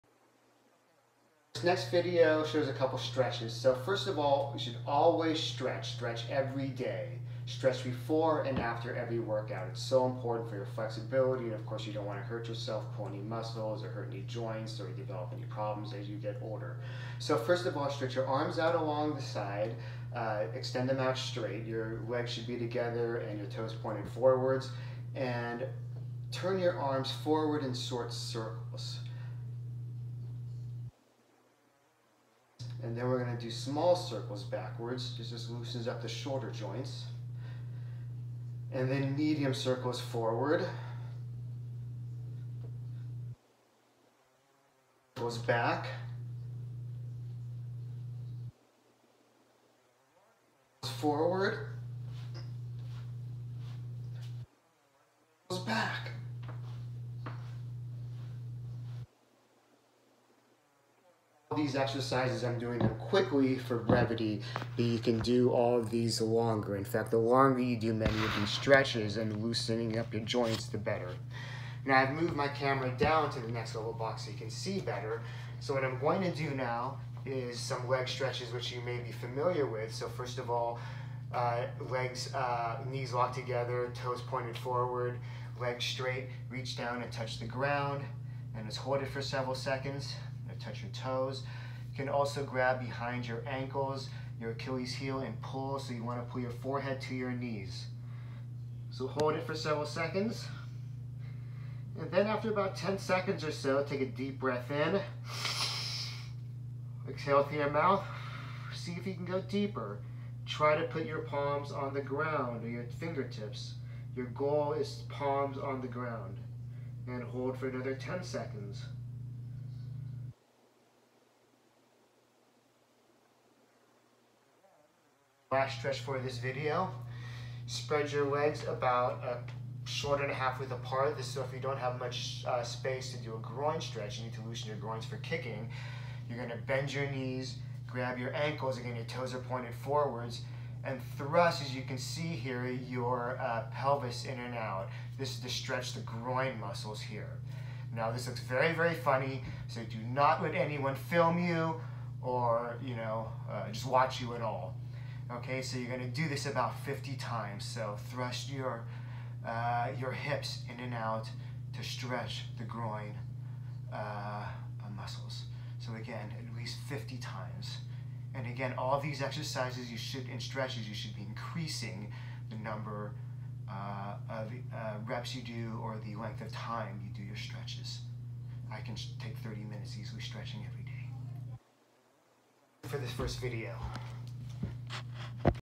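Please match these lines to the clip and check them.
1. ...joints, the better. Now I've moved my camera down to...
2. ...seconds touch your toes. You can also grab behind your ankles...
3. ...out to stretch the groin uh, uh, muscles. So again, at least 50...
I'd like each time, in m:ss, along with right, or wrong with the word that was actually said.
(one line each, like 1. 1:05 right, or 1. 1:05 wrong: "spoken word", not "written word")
1. 1:10 right
2. 1:29 right
3. 2:40 right.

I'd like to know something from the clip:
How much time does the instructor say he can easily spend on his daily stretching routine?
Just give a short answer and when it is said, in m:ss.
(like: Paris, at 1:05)
30 minutes, at 2:59.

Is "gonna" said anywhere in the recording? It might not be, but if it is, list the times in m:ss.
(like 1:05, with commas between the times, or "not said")
2:16, 2:35.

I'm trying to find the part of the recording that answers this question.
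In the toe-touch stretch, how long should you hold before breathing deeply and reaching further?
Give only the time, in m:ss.
1:42.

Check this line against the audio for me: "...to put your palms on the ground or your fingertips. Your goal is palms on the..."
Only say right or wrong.
right.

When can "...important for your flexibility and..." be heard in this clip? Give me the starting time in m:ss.
0:10.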